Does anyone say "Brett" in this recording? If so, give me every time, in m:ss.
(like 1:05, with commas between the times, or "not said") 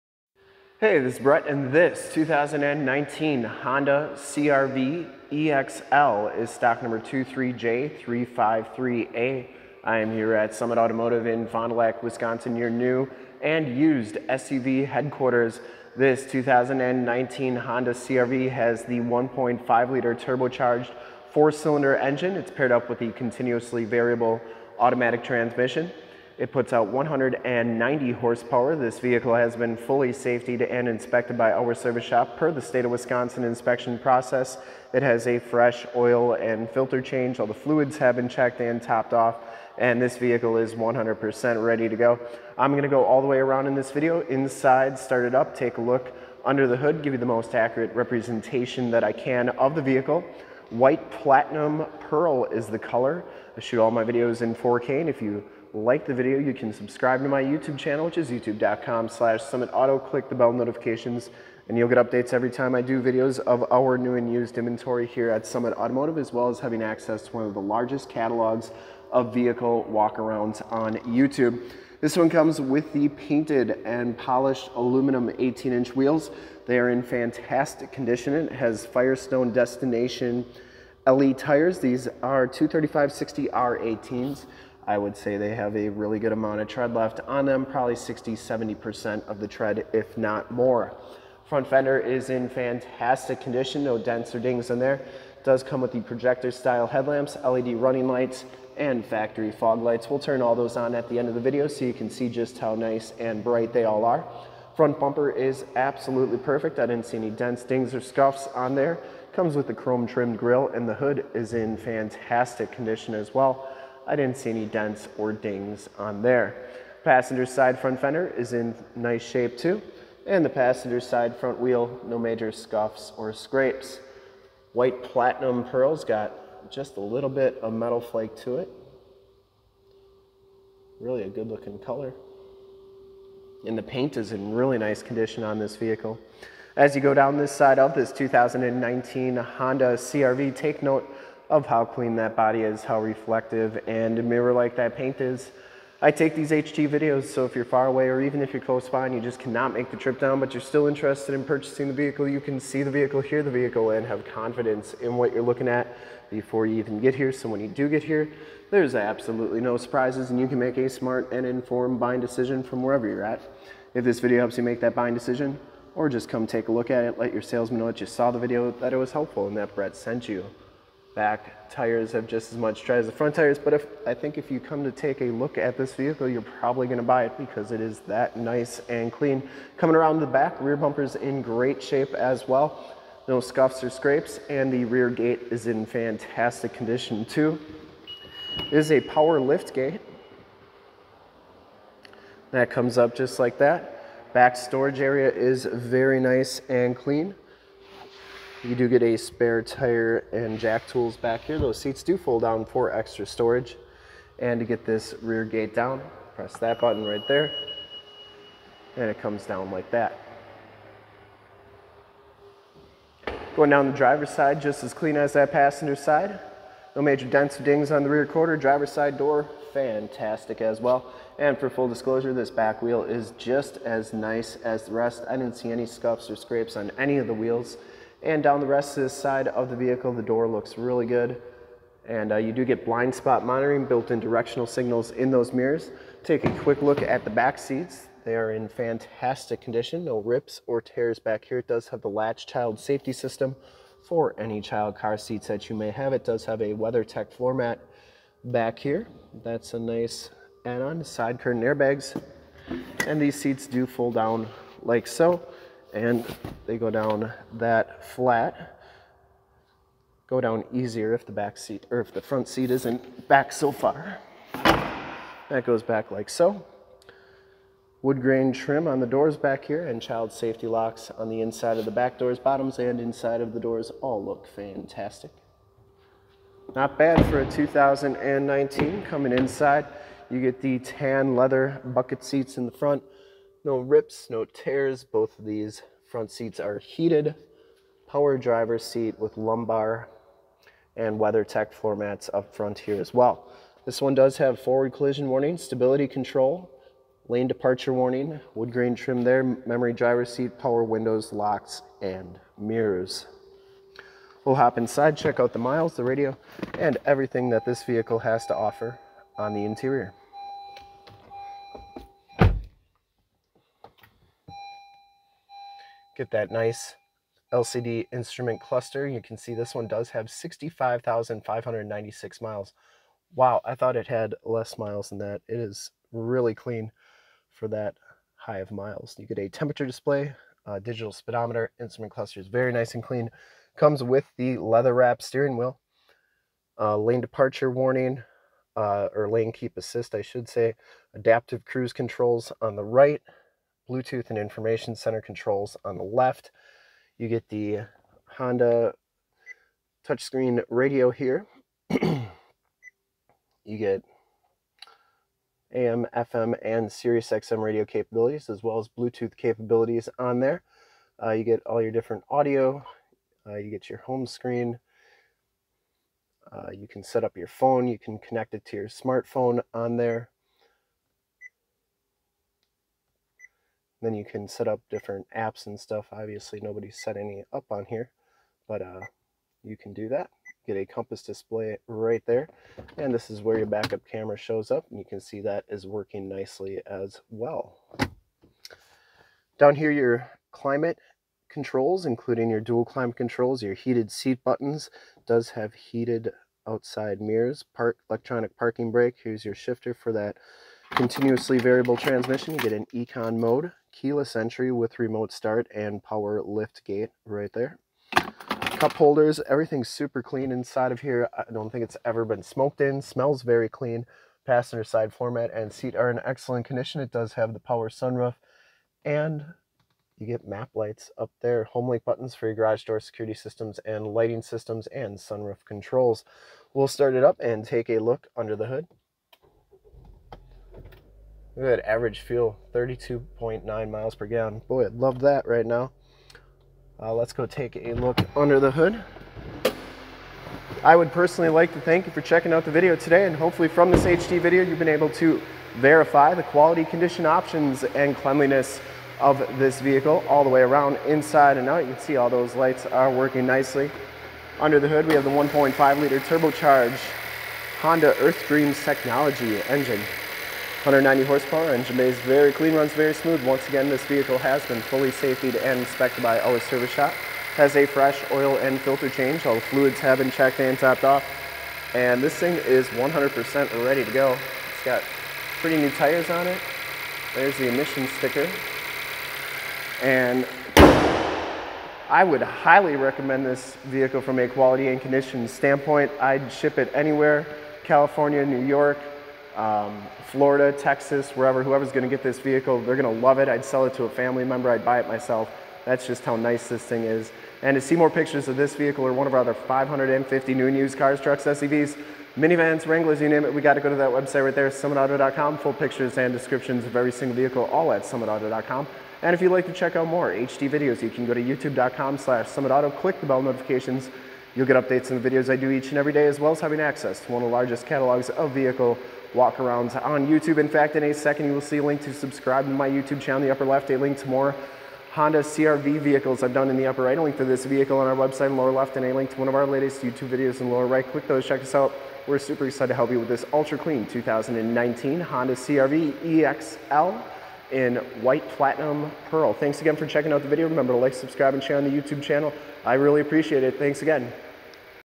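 0:01, 2:49.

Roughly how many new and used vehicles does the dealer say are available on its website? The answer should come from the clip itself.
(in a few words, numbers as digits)
550.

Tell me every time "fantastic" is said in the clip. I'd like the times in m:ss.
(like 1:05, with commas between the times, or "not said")
1:17, 1:32, 1:51, 3:05, 3:39, 3:58, 4:34.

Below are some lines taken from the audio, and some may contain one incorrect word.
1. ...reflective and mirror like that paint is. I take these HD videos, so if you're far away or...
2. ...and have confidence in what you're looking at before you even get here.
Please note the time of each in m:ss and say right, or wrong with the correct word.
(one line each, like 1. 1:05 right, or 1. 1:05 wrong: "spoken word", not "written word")
1. 2:23 right
2. 2:33 right.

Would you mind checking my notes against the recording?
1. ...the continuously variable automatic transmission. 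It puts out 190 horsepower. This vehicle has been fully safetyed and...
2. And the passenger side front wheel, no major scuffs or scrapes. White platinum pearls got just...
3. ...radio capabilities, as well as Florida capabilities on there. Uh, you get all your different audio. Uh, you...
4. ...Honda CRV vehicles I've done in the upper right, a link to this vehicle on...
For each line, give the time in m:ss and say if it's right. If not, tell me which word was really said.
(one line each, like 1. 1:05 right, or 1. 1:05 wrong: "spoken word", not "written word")
1. 0:22 right
2. 2:00 right
3. 5:57 wrong: "Bluetooth", not "Florida"
4. 8:45 right.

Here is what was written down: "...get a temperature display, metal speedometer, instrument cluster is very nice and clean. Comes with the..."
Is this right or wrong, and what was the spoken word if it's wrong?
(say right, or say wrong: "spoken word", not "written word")
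wrong: "digital", not "metal".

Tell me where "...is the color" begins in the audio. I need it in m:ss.
0:52.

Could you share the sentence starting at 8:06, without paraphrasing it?
I'd ship it anywhere, California, New York, um, Florida, Texas, wherever, whoever's gonna get this vehicle, they're gonna love it.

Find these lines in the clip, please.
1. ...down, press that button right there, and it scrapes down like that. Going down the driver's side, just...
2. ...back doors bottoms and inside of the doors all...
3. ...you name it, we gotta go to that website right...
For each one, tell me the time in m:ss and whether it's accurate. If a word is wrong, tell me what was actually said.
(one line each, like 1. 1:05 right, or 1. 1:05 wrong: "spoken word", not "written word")
1. 3:25 wrong: "comes", not "scrapes"
2. 4:31 right
3. 8:23 right.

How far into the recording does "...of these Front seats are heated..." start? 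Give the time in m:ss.
4:45.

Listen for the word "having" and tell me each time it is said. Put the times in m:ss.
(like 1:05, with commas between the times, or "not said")
1:06, 8:36.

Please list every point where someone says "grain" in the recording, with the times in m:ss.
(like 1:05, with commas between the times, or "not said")
4:28, 4:58.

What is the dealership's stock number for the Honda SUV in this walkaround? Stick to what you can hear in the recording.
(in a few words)
23J353A.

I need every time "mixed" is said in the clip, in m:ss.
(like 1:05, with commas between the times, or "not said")
not said.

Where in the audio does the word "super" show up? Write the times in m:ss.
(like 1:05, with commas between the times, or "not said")
6:49, 8:52.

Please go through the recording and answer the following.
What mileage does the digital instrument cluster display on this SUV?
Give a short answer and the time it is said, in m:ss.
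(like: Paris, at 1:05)
65,596 miles, at 5:20.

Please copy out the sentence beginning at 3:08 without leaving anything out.
It is a power lift gate.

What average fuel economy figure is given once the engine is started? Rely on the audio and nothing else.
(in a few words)
32.9 mpg.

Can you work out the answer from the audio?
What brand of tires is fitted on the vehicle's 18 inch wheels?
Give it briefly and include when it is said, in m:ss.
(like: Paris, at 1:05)
Firestone Destination LE, at 1:18.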